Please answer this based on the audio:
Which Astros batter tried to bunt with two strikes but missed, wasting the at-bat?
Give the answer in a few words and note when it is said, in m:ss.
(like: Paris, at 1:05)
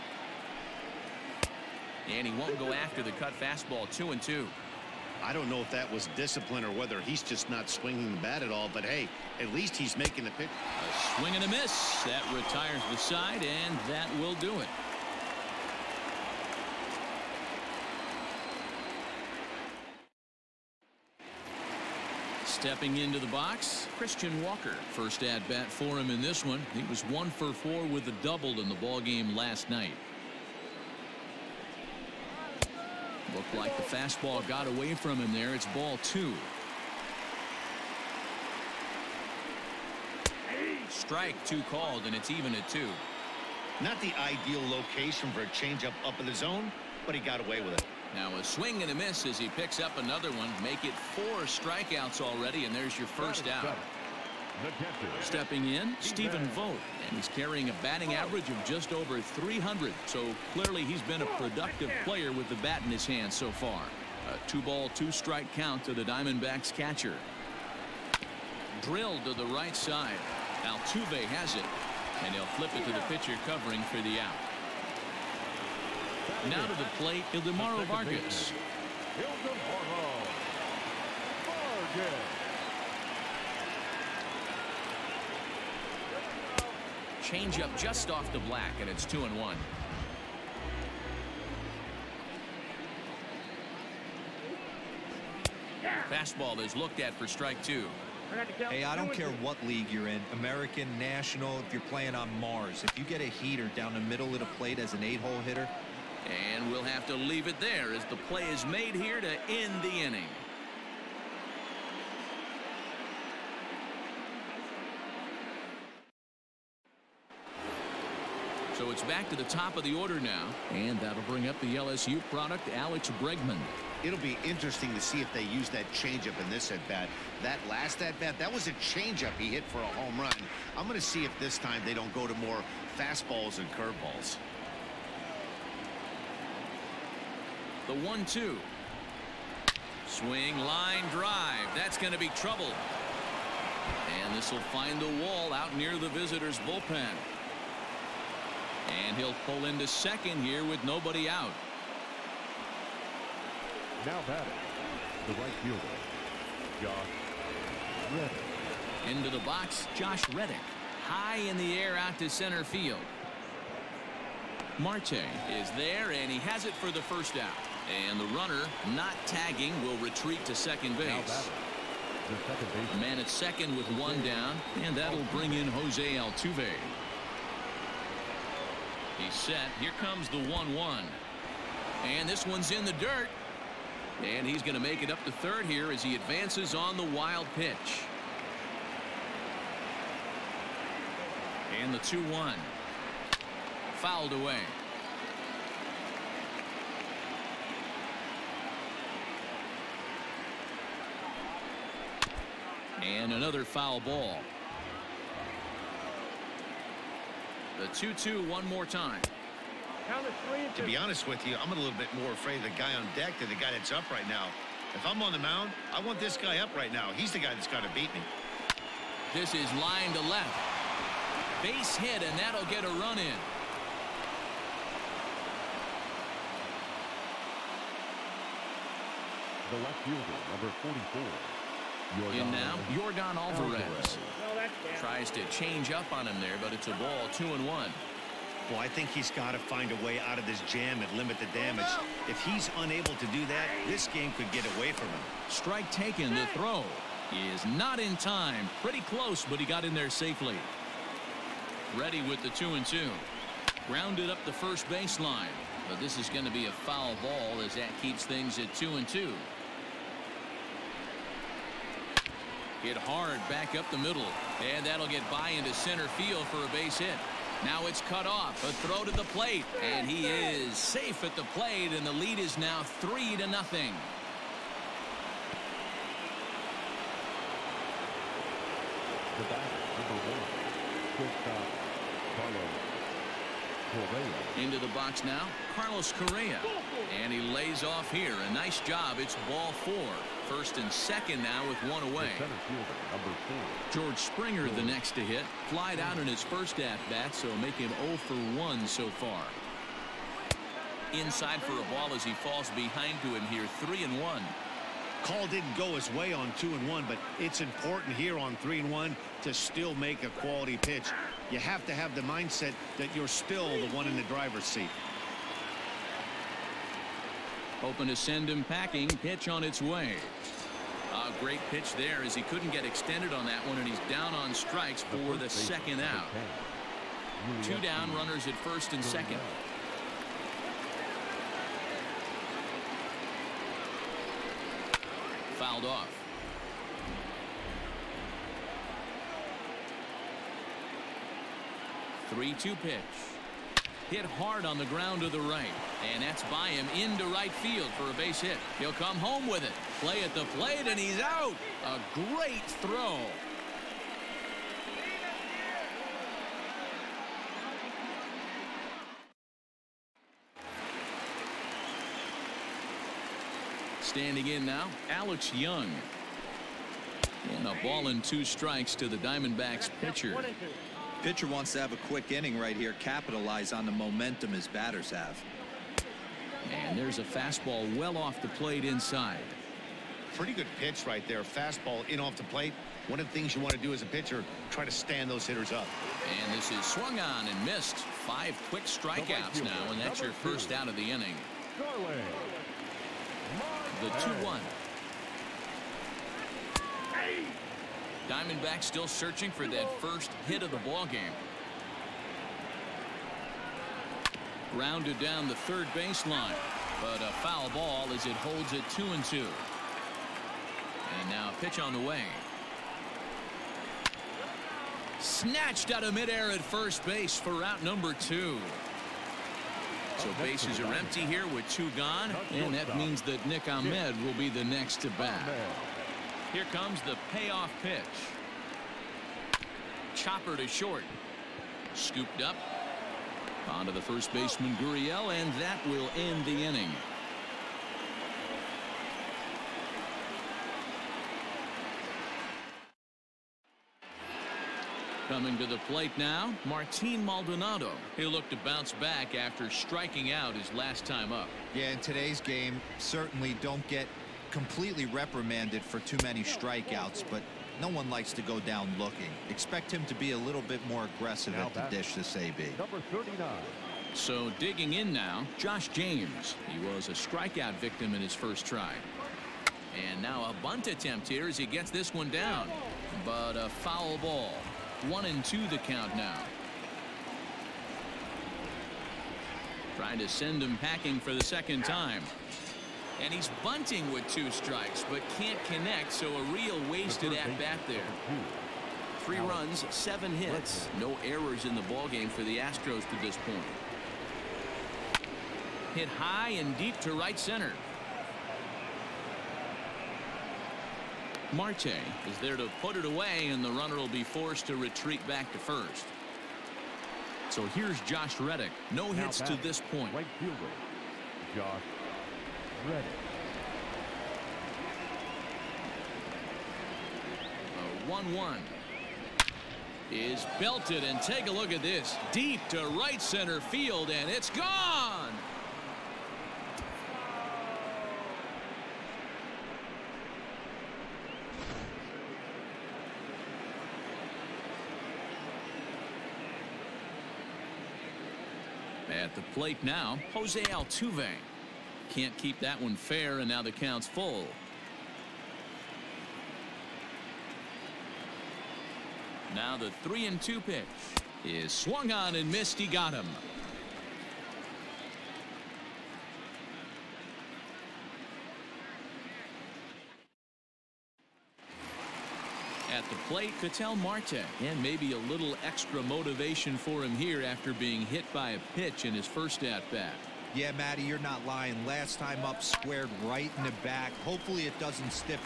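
Josh James, at 7:45.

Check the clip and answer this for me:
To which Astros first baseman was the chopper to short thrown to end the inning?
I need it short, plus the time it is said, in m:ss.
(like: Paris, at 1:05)
Gurriel, at 7:14.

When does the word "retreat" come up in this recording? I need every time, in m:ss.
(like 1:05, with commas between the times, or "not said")
2:49, 8:24.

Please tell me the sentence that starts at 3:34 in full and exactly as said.
If I'm on the mound, I want this guy up right now.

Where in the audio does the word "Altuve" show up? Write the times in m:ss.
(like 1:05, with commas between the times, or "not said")
1:10, 2:56, 9:00.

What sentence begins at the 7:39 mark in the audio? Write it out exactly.
Expect him to be a little bit more aggressive now at the dish this AB.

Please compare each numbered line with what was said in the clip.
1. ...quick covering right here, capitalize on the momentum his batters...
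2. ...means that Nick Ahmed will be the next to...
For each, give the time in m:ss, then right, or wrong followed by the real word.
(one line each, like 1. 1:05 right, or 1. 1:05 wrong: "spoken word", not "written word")
1. 6:12 wrong: "inning", not "covering"
2. 7:02 right.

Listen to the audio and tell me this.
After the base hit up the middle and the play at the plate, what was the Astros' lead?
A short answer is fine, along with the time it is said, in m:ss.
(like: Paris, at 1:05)
3 to 0, at 4:32.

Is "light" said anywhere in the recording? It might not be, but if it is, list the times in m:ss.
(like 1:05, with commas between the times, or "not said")
not said.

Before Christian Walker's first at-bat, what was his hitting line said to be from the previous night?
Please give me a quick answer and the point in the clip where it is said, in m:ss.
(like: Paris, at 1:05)
1 for 4 with a double, at 0:27.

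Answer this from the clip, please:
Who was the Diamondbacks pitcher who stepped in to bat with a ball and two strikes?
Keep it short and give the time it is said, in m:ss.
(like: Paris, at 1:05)
Alex Young, at 6:05.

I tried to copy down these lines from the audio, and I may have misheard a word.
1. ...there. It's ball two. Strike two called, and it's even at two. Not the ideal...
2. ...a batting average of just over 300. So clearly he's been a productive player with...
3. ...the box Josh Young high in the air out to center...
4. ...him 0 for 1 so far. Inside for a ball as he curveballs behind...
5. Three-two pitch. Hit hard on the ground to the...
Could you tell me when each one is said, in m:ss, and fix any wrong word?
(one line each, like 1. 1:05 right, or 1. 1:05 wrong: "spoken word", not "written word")
1. 0:35 right
2. 0:57 right
3. 2:39 wrong: "Reddick", not "Young"
4. 4:57 wrong: "falls", not "curveballs"
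5. 5:42 right.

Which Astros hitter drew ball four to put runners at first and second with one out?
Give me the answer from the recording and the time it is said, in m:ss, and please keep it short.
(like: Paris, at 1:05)
Carlos Correa, at 4:45.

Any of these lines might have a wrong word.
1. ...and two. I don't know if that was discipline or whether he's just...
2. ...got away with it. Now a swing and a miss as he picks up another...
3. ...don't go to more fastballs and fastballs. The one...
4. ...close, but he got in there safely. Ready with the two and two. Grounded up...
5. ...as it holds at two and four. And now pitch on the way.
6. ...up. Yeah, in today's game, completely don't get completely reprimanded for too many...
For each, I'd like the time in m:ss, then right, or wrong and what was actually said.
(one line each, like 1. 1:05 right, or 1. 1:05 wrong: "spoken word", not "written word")
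1. 0:04 right
2. 0:47 right
3. 2:11 wrong: "curveballs", not "fastballs"
4. 4:09 right
5. 6:48 wrong: "two", not "four"
6. 7:31 wrong: "certainly", not "completely".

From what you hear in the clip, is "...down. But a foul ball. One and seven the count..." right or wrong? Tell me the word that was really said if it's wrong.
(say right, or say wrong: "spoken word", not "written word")
wrong: "two", not "seven".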